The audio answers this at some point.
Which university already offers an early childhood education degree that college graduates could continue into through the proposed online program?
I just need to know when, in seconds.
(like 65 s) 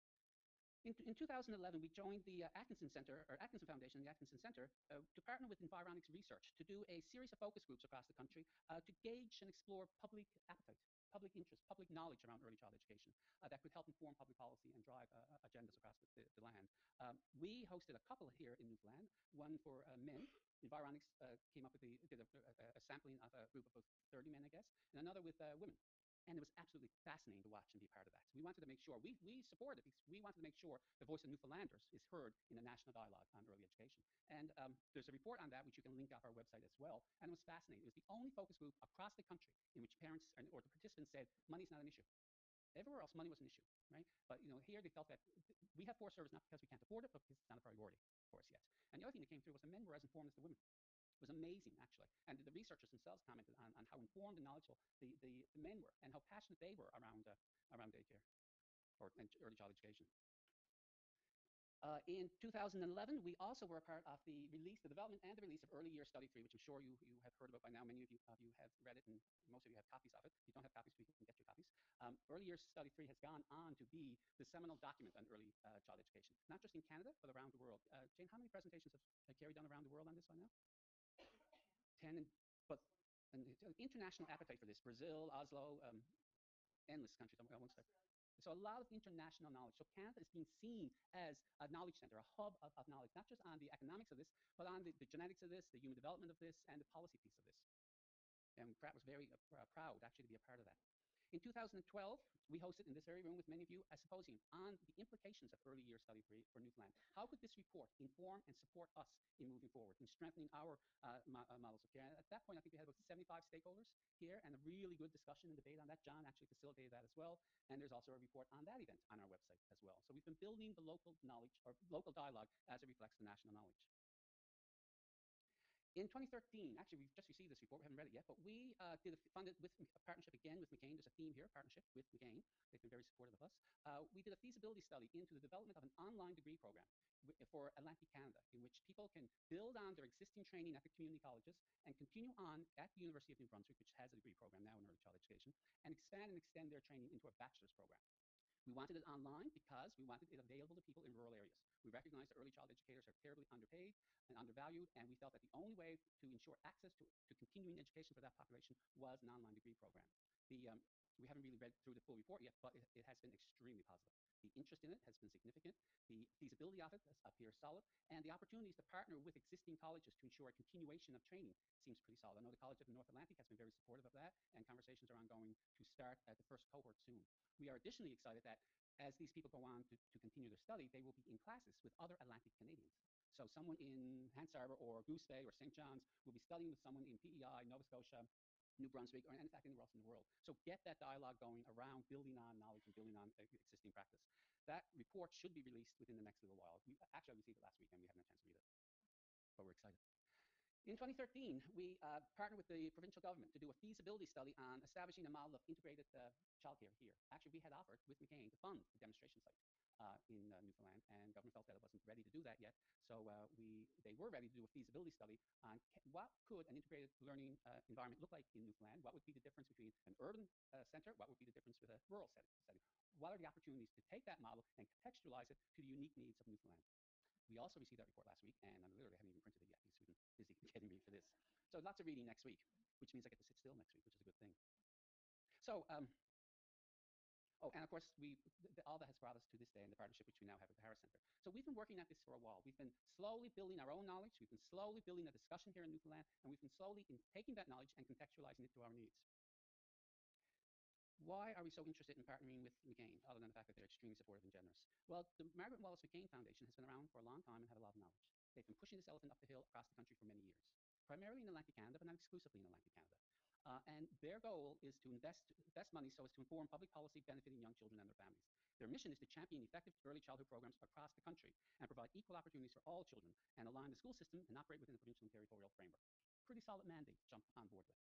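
143 s.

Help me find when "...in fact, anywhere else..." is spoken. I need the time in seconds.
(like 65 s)
189 s.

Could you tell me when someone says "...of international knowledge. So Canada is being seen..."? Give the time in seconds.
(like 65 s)
88 s.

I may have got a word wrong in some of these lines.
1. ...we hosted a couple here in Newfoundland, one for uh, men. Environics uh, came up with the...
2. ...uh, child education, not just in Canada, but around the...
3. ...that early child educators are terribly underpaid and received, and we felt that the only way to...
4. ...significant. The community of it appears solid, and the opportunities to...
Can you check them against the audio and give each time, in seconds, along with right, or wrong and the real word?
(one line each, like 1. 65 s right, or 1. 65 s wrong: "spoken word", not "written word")
1. 17 s right
2. 75 s right
3. 152 s wrong: "undervalued", not "received"
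4. 165 s wrong: "feasibility", not "community".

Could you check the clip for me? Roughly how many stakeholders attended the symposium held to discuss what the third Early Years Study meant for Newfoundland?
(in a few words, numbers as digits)
75.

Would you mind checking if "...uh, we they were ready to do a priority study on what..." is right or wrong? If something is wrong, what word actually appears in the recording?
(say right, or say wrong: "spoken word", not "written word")
wrong: "feasibility", not "priority".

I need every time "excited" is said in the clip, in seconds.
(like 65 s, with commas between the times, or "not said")
178 s, 199 s.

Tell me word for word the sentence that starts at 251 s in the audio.
Why are we so interested in partnering with McCain, other than the fact that they're extremely supportive and generous?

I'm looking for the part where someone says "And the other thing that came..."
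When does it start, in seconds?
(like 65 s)
48 s.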